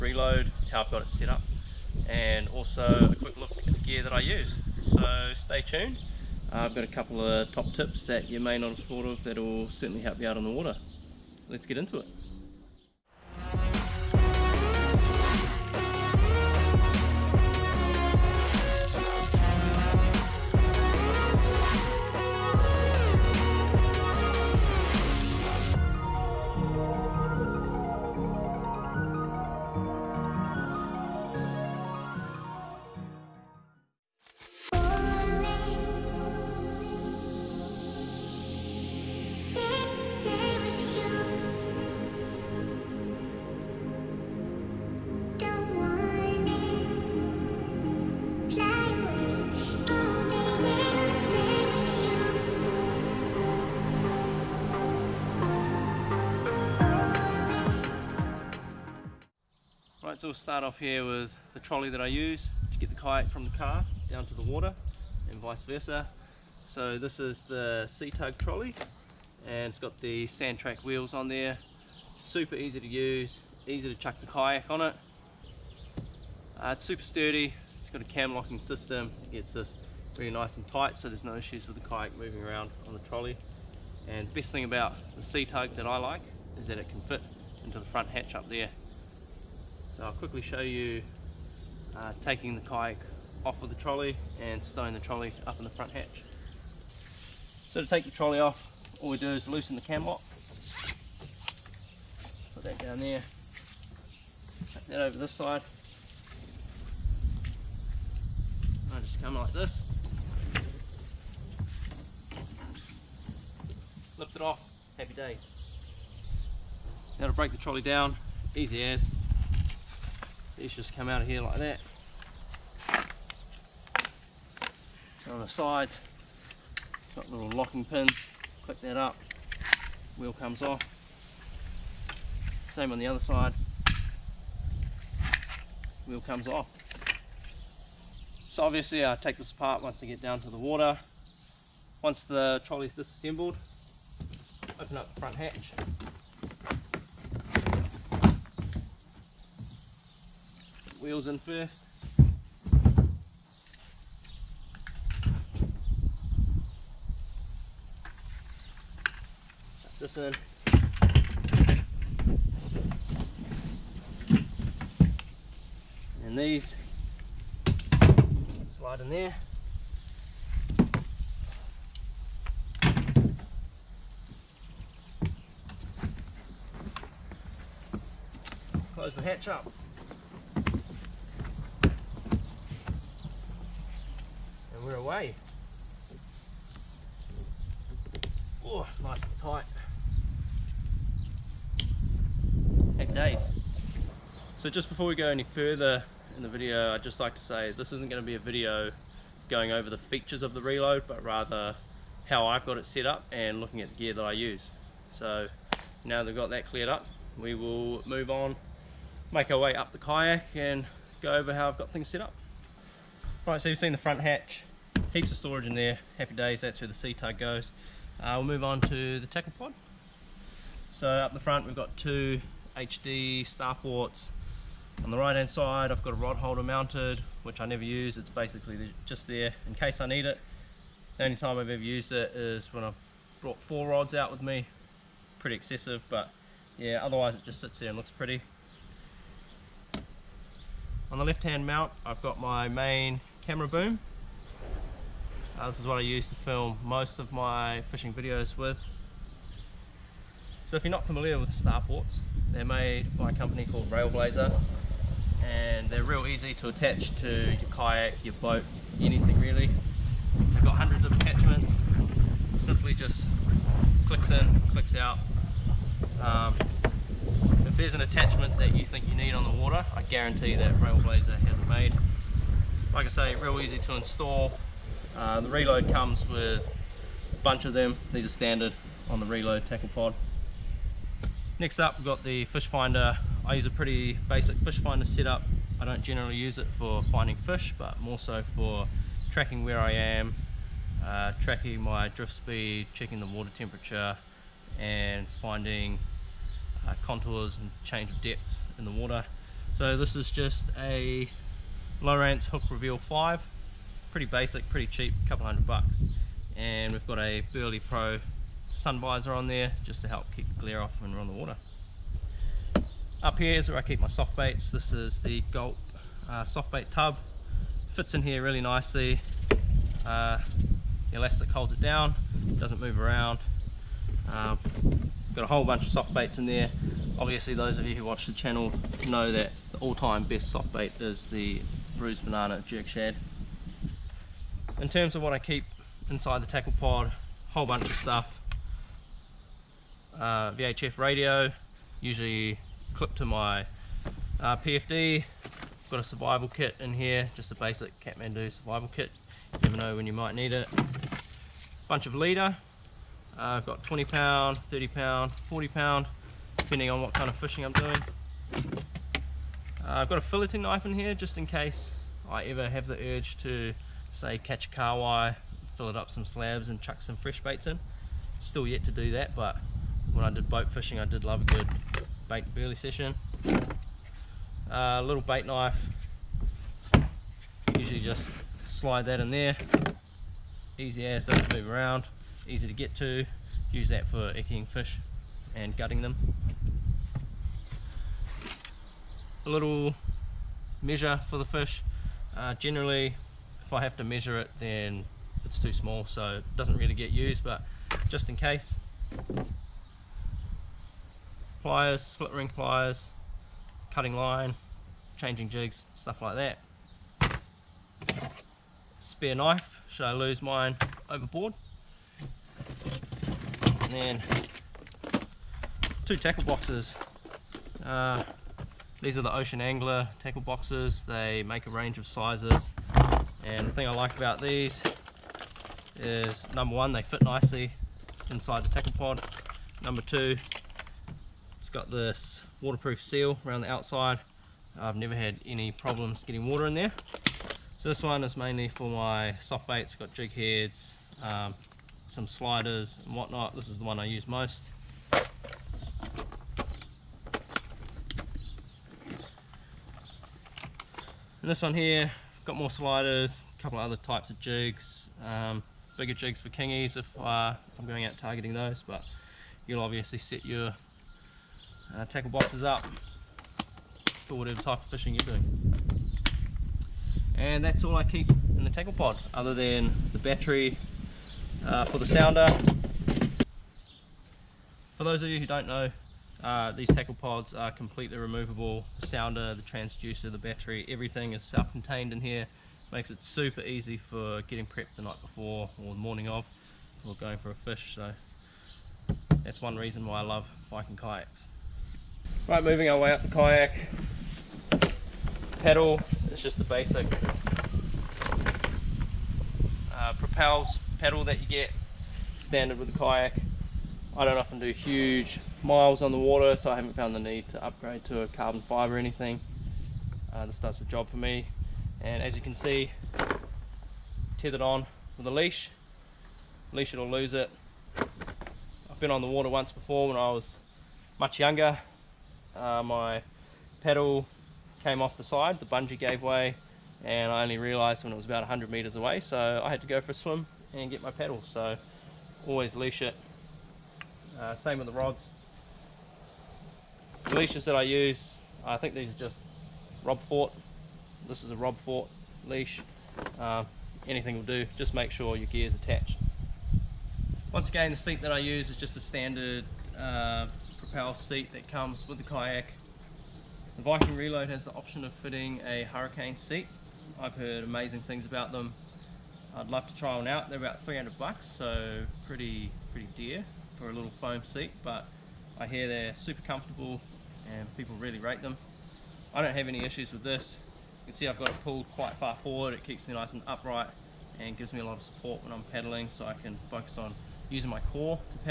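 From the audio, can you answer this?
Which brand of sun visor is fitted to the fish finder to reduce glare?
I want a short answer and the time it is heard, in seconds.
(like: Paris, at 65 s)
Berley Pro, at 307 s.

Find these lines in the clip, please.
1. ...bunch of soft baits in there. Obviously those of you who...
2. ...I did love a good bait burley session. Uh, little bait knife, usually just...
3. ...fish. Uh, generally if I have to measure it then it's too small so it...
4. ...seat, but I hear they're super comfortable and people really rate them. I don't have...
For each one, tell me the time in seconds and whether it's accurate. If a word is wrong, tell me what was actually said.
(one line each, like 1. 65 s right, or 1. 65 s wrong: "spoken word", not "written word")
1. 325 s right
2. 370 s right
3. 391 s right
4. 564 s right.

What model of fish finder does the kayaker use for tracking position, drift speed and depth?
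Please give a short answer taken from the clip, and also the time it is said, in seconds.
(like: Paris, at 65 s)
Lowrance Hook Reveal 5, at 302 s.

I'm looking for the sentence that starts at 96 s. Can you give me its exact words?
So to take the trolley off, all we do is loosen the cam lock.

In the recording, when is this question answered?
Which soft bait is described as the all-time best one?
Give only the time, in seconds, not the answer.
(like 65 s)
331 s.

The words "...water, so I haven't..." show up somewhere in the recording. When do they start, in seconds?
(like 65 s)
506 s.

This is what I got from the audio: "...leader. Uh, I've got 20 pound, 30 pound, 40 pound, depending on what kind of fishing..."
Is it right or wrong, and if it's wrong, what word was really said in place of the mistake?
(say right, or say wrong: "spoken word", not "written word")
right.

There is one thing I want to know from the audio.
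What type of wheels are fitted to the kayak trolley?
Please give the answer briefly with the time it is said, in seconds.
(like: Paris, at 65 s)
Sand track wheels, at 70 s.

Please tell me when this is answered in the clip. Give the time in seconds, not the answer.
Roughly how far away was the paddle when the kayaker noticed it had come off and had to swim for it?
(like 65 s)
528 s.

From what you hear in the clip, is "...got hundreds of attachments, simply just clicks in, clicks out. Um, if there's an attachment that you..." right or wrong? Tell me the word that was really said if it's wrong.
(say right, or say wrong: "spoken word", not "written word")
right.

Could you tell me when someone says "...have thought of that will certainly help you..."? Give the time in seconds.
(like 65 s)
8 s.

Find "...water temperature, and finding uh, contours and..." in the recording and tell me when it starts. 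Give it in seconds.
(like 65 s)
293 s.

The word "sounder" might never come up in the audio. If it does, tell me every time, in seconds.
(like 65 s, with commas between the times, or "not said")
472 s, 479 s.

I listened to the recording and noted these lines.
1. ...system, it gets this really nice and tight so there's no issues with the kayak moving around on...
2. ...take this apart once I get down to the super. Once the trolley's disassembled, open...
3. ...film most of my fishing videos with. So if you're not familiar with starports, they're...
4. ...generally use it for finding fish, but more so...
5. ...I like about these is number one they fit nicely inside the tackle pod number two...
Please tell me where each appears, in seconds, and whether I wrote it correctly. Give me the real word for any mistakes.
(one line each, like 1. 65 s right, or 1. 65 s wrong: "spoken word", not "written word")
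1. 78 s right
2. 139 s wrong: "water", not "super"
3. 246 s right
4. 286 s right
5. 423 s right.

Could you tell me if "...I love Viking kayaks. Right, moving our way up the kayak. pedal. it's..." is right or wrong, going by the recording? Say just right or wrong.
right.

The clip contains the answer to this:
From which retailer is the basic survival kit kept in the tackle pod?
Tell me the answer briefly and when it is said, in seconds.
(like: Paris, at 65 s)
Kathmandu, at 347 s.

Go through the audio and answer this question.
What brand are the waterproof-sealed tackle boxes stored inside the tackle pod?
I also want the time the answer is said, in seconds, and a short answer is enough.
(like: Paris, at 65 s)
Ocean Angler, at 419 s.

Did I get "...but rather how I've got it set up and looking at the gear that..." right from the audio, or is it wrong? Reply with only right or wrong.
right.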